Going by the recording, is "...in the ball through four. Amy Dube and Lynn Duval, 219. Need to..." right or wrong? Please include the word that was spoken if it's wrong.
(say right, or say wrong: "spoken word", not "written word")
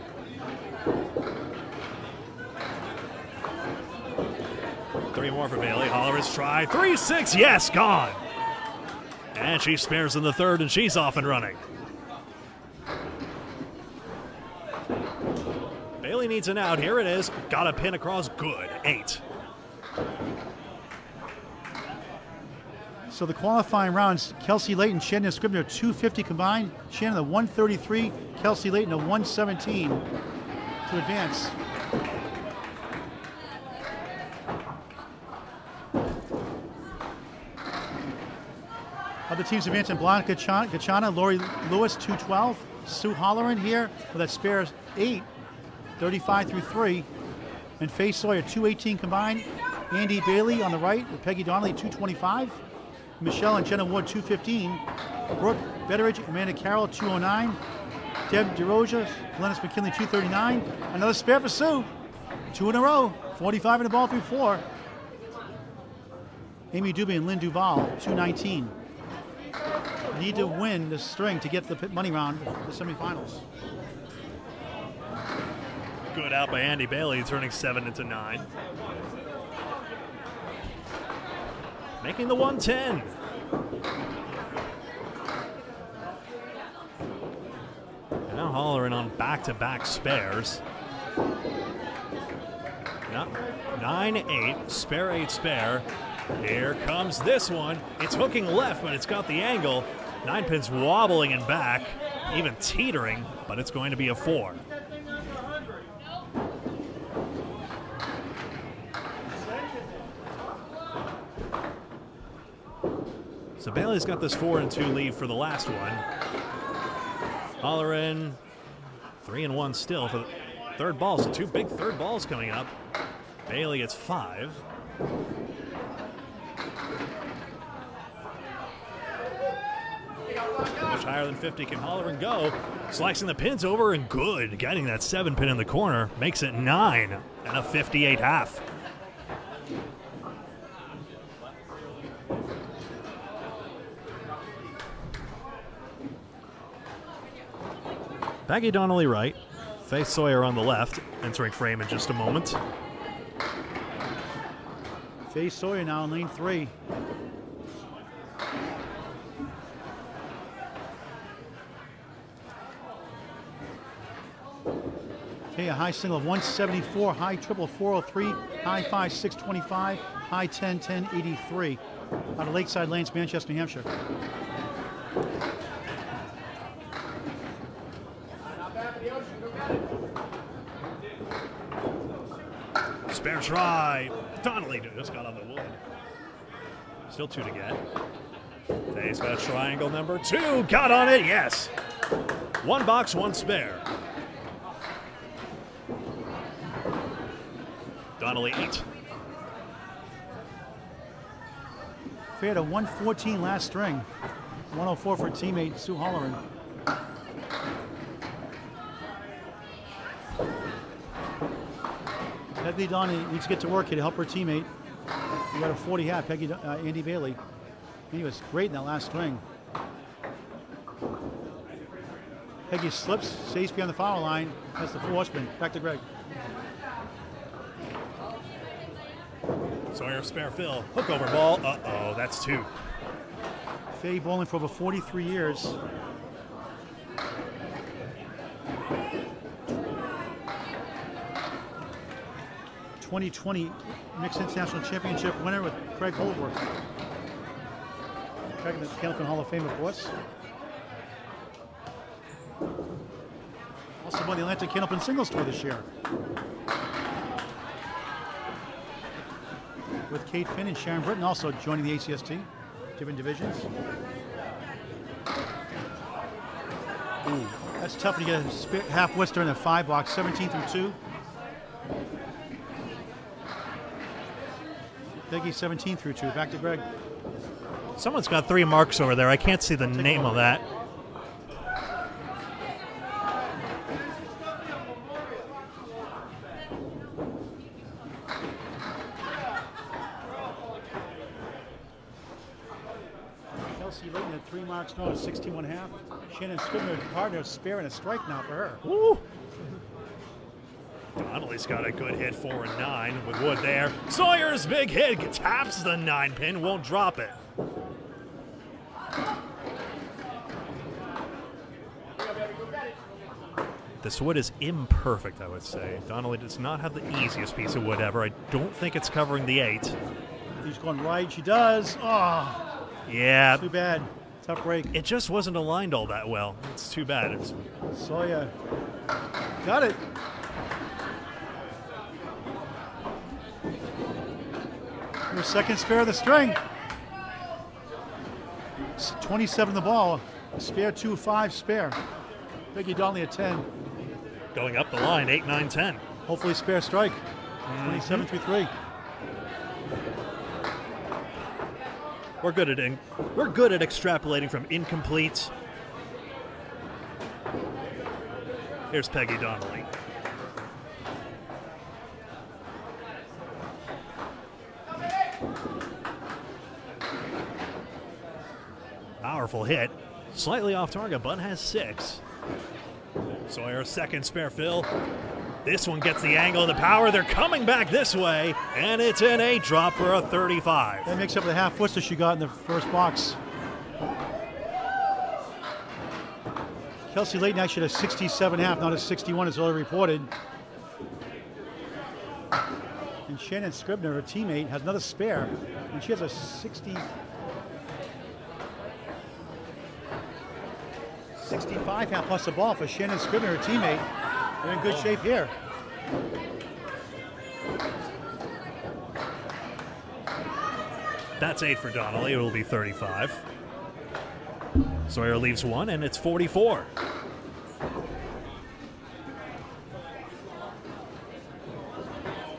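right.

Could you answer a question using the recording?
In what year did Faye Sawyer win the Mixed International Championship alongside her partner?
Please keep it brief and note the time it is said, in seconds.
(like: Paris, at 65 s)
2020, at 243 s.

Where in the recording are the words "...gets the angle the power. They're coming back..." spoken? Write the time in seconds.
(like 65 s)
375 s.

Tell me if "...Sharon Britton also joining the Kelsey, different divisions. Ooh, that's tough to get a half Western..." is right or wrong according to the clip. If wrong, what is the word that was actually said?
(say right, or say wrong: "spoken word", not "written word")
wrong: "ACST", not "Kelsey".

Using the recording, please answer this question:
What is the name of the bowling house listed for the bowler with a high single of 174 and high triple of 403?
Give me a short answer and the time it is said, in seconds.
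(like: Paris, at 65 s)
Lakeside Lanes, at 172 s.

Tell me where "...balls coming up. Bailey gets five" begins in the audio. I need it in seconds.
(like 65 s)
121 s.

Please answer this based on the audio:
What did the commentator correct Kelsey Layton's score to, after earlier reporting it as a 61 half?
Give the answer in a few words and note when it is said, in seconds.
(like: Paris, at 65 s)
67 half, at 387 s.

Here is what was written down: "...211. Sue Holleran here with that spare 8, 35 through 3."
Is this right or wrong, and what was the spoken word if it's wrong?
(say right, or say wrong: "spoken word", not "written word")
wrong: "212", not "211".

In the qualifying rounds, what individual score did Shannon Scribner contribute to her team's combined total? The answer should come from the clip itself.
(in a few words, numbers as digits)
133.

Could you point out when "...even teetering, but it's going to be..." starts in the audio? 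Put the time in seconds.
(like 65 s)
102 s.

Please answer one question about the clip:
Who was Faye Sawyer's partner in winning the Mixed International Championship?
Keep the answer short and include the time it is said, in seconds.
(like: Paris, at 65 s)
Craig Holworth, at 245 s.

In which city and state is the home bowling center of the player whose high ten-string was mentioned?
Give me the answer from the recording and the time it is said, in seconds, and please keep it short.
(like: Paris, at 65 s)
Manchester, New Hampshire, at 173 s.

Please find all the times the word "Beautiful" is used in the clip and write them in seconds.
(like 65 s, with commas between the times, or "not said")
369 s.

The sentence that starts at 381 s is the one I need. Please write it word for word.
That makes up the half foot that she got in the first box.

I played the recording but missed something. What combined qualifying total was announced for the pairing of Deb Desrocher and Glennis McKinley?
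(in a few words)
239.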